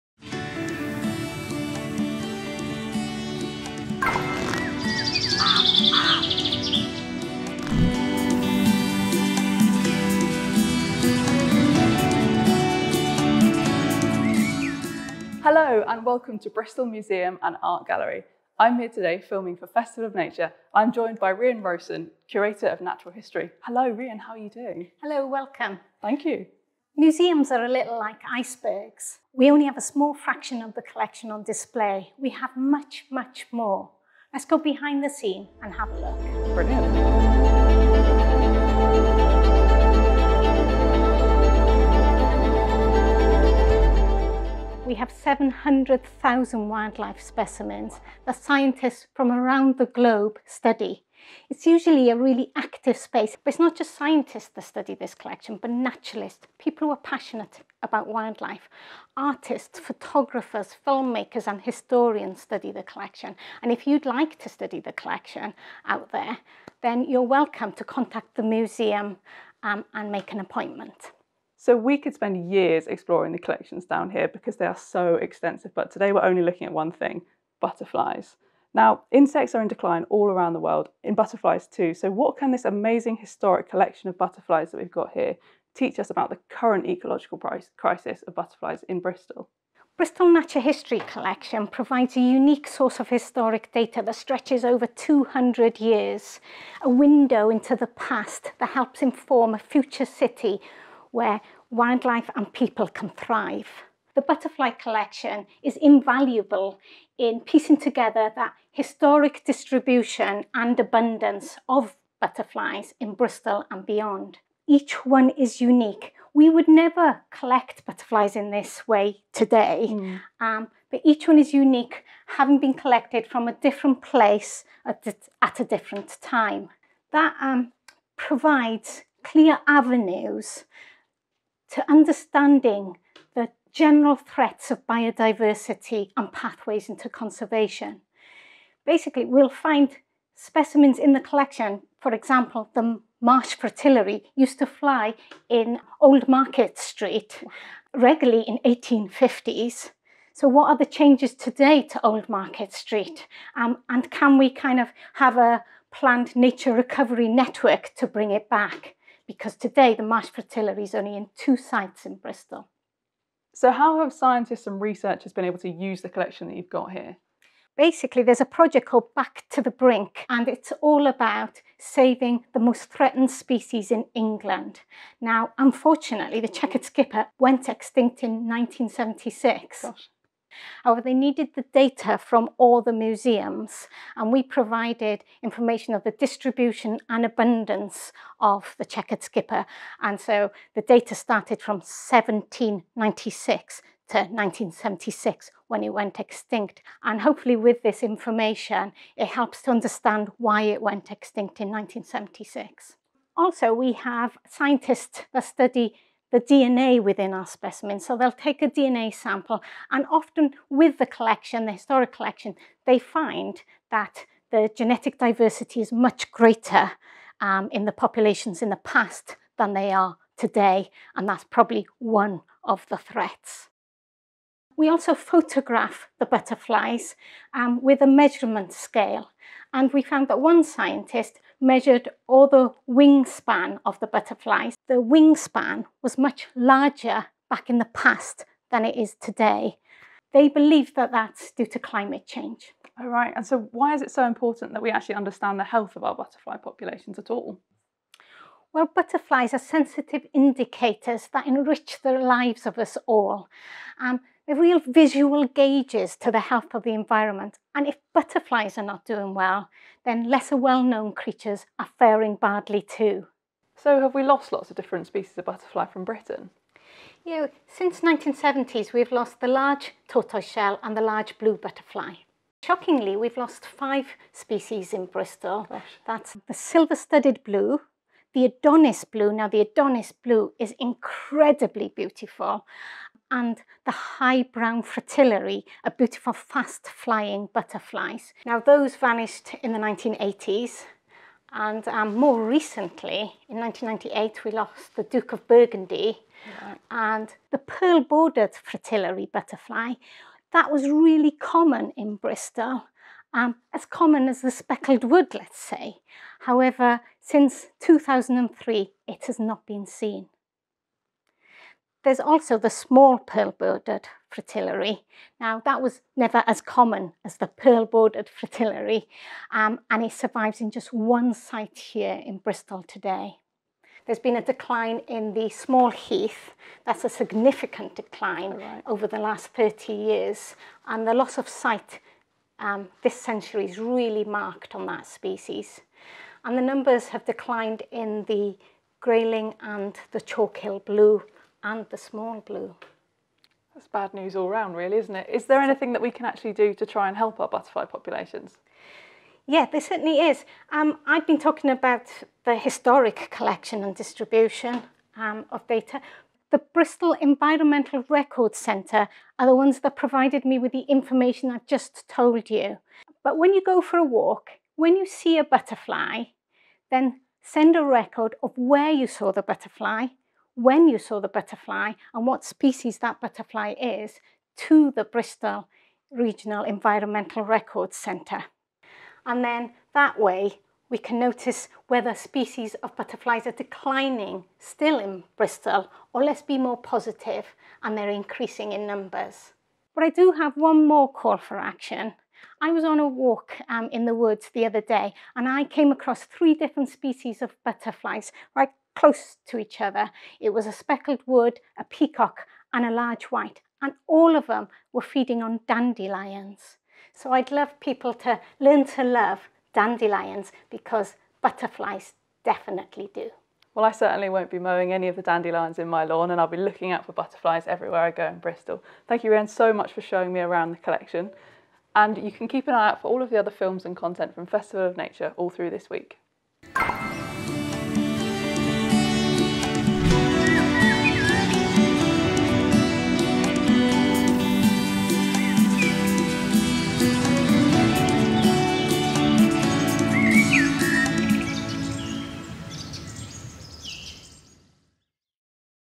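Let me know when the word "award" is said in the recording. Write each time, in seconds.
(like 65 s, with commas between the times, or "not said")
not said.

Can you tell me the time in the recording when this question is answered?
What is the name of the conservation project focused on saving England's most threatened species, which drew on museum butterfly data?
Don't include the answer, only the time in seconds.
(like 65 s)
169 s.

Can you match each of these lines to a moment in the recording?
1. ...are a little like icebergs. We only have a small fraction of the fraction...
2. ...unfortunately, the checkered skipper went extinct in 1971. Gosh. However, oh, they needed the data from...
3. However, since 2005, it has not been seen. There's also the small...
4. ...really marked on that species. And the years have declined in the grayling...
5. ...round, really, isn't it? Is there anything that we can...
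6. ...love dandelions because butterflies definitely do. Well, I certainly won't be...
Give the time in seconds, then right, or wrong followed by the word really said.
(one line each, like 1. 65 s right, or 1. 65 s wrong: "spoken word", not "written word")
1. 27 s wrong: "collection", not "fraction"
2. 175 s wrong: "1976", not "1971"
3. 306 s wrong: "2003", not "2005"
4. 333 s wrong: "numbers", not "years"
5. 344 s right
6. 409 s right.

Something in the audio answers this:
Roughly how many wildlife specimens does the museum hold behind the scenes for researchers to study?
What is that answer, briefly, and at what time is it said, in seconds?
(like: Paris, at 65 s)
700,000, at 45 s.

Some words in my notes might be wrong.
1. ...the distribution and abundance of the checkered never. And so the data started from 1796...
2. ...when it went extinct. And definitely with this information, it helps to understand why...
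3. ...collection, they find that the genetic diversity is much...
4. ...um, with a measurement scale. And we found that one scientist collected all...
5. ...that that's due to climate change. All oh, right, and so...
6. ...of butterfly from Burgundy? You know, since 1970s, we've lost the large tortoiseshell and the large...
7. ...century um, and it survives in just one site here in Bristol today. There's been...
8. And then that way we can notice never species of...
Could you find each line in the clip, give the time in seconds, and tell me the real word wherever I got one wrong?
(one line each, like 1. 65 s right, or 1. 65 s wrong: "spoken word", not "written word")
1. 186 s wrong: "skipper", not "never"
2. 195 s wrong: "hopefully", not "definitely"
3. 212 s right
4. 227 s wrong: "measured", not "collected"
5. 240 s right
6. 265 s wrong: "Britain", not "Burgundy"
7. 318 s wrong: "fritillary", not "century"
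8. 379 s wrong: "whether", not "never".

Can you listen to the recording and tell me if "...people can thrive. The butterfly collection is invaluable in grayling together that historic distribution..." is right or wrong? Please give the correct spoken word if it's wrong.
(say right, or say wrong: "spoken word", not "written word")
wrong: "piecing", not "grayling".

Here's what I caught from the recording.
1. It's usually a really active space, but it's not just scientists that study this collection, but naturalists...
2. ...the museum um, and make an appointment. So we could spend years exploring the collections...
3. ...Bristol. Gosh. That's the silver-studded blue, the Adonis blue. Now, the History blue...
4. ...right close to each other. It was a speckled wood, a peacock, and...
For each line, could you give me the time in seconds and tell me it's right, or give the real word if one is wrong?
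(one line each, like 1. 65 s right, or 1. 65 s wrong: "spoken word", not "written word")
1. 51 s right
2. 68 s right
3. 275 s wrong: "Adonis", not "History"
4. 398 s right.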